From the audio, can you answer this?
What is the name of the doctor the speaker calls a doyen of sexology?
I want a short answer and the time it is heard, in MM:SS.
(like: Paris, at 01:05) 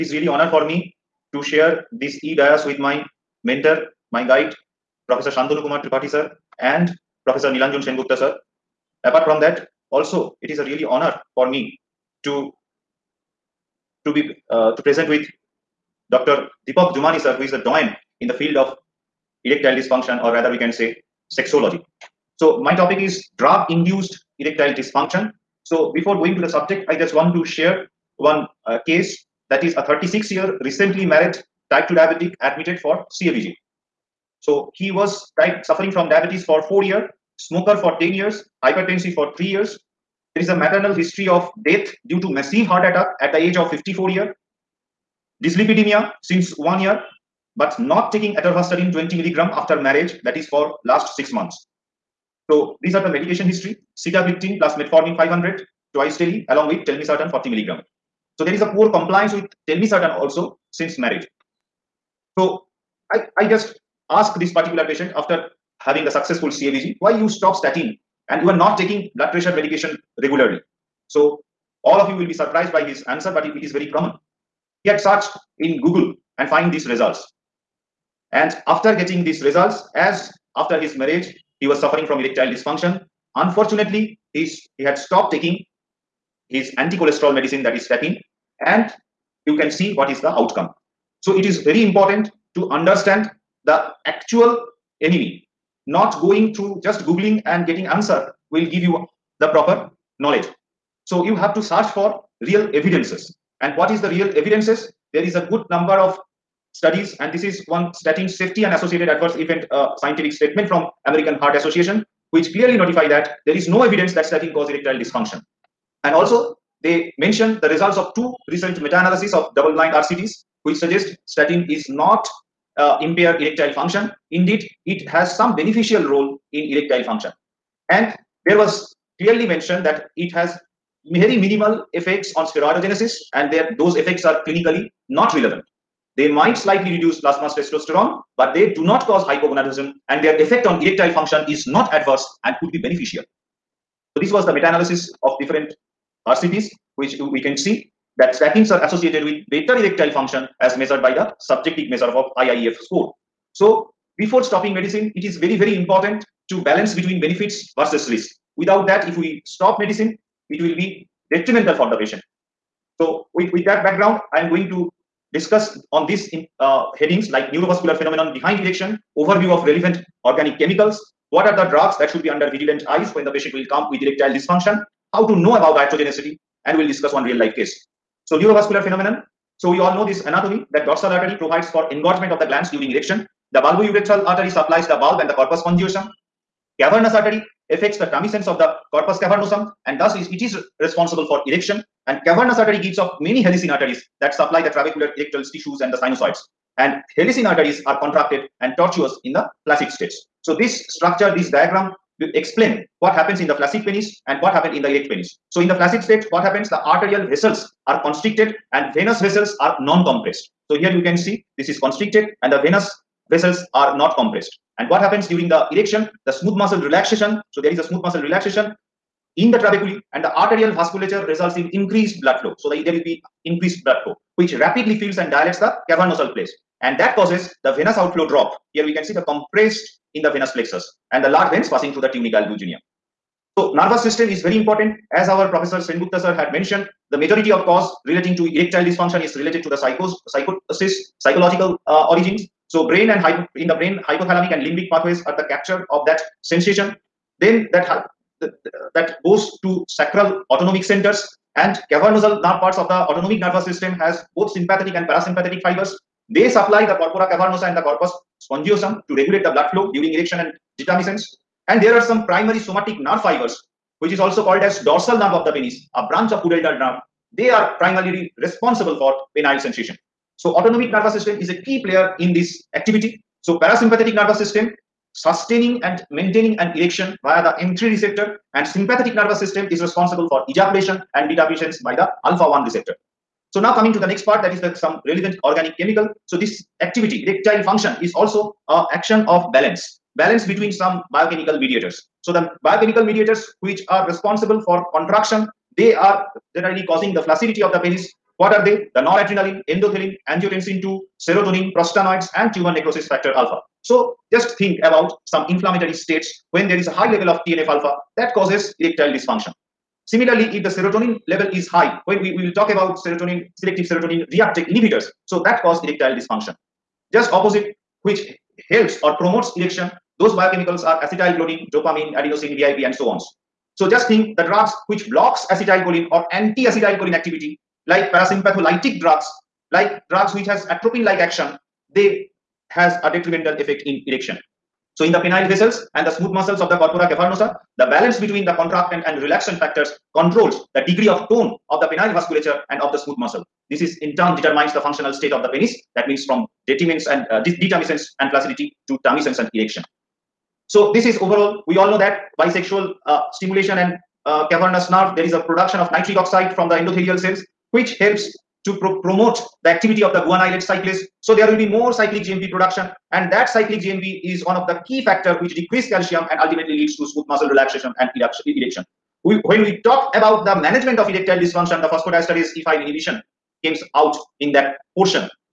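Deepak Jumani, at 00:16.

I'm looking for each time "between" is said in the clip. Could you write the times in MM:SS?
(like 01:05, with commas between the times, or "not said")
02:36, 04:50, 05:38.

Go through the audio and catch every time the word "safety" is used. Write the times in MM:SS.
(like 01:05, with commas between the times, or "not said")
01:48.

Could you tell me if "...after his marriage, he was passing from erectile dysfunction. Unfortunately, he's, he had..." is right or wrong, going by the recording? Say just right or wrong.
wrong.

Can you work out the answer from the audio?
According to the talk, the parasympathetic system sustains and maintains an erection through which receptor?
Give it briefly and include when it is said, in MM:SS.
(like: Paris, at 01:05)
M3 receptor, at 04:37.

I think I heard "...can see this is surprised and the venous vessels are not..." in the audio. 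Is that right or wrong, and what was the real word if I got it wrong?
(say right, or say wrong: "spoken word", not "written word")
wrong: "constricted", not "surprised".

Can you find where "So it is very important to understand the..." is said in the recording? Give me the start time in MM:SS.
01:31.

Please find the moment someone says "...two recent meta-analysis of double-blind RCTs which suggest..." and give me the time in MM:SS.
01:58.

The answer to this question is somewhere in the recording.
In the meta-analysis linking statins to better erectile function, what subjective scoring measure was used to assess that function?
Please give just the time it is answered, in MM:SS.
02:32.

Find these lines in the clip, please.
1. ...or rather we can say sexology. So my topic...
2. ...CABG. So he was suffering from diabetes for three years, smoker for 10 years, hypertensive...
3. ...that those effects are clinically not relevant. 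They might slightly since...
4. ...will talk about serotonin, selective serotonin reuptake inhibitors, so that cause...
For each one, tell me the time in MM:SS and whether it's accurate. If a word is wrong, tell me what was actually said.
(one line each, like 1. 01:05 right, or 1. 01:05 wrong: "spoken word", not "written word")
1. 00:20 right
2. 00:33 wrong: "four", not "three"
3. 02:13 wrong: "reduce", not "since"
4. 05:12 right.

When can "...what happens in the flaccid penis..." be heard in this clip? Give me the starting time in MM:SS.
03:23.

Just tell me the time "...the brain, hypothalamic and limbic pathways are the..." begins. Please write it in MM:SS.
04:03.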